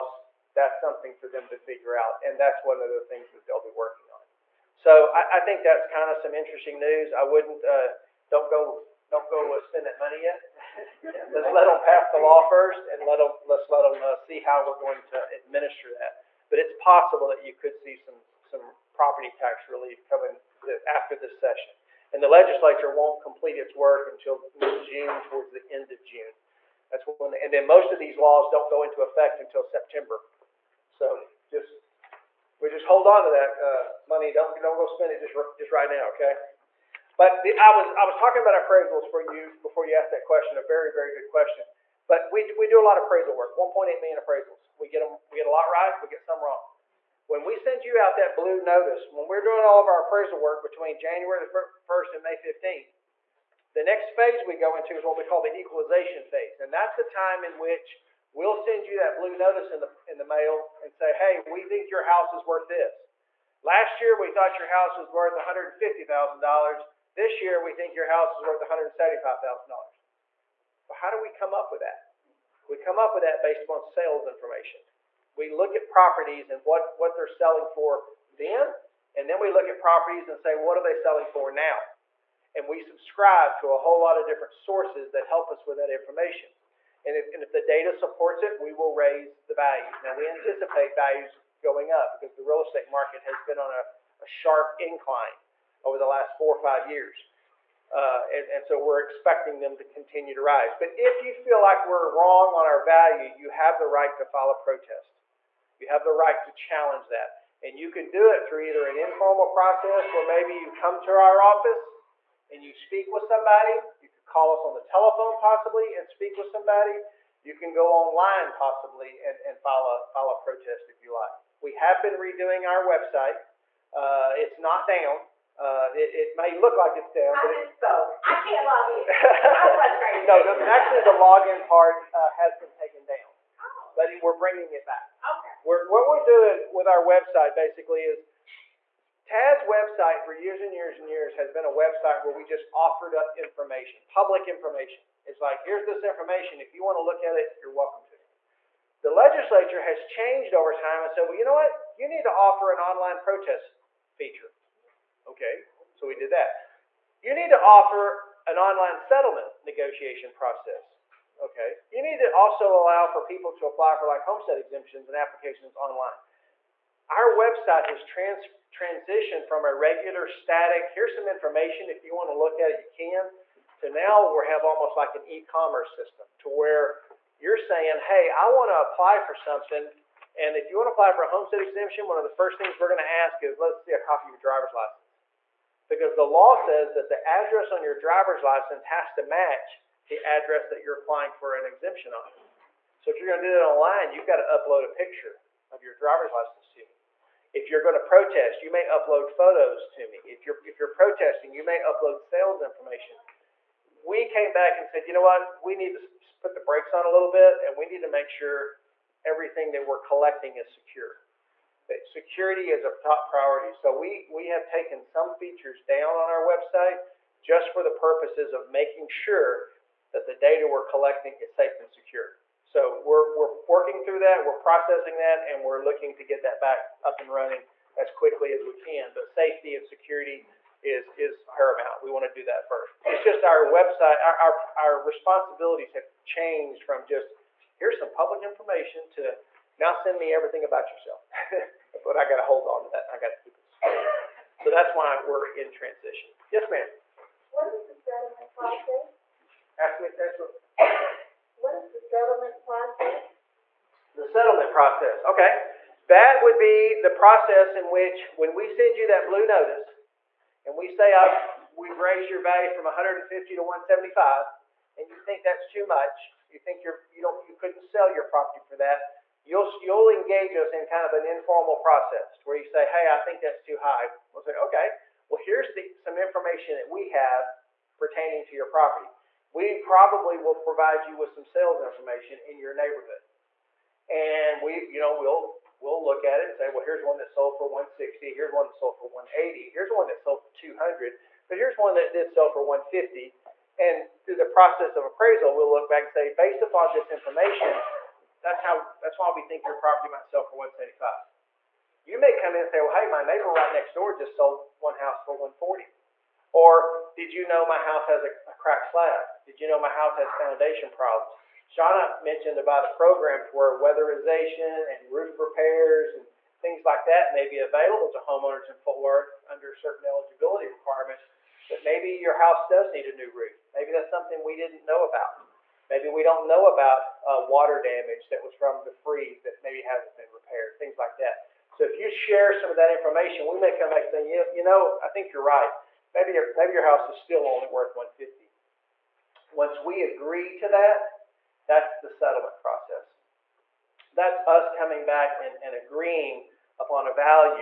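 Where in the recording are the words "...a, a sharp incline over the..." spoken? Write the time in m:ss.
1:33.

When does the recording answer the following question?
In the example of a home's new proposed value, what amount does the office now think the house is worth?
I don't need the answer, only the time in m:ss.
1:08.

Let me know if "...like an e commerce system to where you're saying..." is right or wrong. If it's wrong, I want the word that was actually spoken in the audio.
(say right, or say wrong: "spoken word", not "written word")
right.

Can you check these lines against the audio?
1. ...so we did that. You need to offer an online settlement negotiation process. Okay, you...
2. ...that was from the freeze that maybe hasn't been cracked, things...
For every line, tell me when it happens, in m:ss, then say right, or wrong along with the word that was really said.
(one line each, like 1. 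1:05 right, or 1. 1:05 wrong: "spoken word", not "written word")
1. 2:35 right
2. 5:28 wrong: "repaired", not "cracked".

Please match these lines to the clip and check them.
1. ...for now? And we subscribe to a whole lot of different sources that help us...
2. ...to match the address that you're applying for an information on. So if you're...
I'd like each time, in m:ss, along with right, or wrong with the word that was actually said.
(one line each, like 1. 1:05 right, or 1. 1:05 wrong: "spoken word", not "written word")
1. 1:21 right
2. 3:09 wrong: "exemption", not "information".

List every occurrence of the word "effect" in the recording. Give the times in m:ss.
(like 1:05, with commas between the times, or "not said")
0:29.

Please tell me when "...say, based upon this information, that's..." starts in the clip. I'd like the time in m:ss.
4:56.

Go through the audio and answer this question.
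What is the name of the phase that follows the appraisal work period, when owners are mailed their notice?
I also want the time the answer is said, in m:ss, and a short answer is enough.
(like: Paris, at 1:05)
equalization phase, at 0:55.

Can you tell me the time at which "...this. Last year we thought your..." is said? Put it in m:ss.
1:02.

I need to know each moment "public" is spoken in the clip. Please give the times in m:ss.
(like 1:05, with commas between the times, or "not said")
2:24, 3:58.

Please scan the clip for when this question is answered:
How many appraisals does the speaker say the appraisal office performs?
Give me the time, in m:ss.
0:43.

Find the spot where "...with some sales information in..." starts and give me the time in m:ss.
4:41.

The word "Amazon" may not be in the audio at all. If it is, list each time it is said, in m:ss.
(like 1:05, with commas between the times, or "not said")
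not said.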